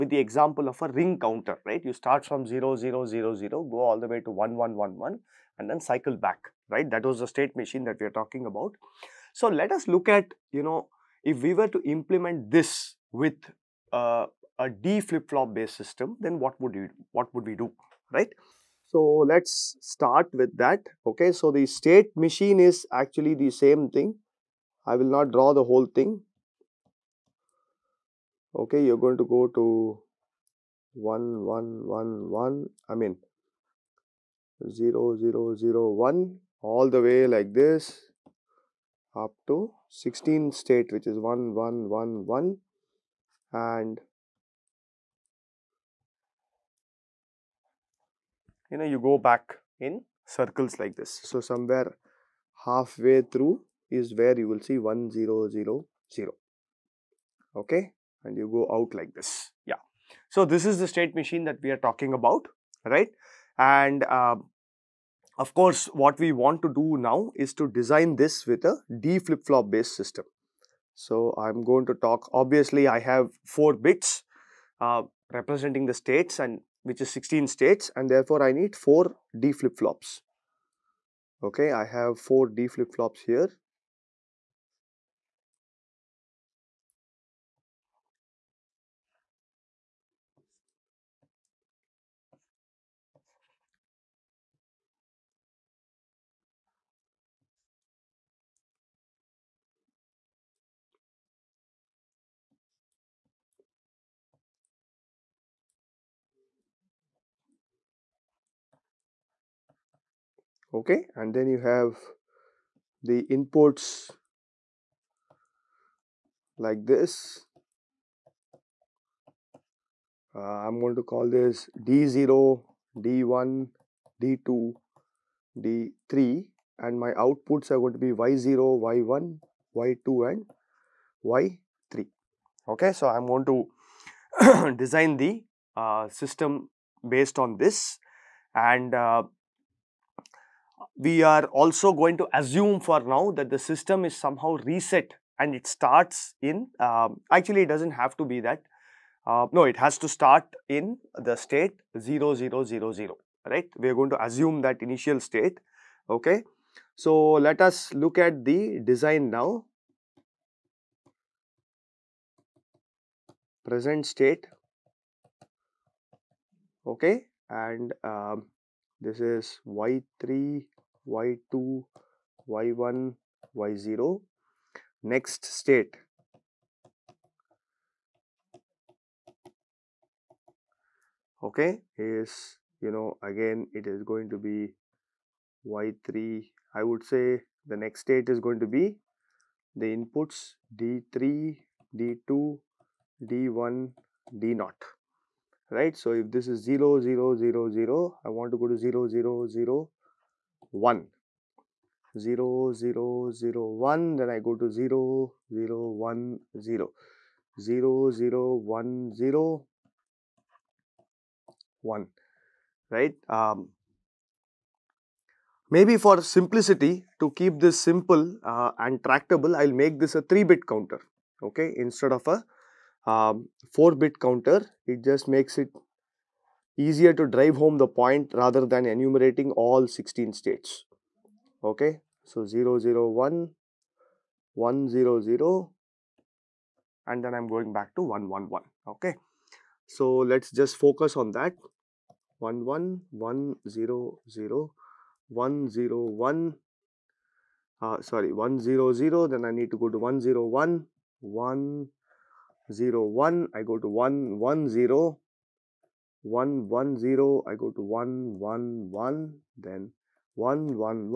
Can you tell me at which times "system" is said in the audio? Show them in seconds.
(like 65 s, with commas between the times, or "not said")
15 s, 69 s, 136 s, 143 s.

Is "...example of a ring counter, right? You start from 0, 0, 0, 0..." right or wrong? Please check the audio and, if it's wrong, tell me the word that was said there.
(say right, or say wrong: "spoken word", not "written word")
right.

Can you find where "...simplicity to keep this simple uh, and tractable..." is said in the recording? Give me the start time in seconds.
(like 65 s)
216 s.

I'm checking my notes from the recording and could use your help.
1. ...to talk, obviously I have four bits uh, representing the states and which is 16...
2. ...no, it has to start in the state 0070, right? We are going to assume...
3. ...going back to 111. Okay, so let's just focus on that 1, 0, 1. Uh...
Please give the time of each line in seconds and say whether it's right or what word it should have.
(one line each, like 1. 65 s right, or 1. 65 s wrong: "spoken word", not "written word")
1. 71 s right
2. 149 s wrong: "0000", not "0070"
3. 237 s right.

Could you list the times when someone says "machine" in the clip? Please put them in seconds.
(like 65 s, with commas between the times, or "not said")
7 s, 22 s, 61 s.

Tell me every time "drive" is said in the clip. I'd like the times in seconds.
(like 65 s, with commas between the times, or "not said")
227 s.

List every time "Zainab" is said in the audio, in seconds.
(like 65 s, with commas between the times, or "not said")
not said.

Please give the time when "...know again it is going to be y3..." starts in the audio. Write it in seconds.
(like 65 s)
182 s.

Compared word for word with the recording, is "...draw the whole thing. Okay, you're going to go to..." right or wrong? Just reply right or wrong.
right.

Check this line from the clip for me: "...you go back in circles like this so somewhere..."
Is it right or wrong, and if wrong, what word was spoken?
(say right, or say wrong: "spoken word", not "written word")
right.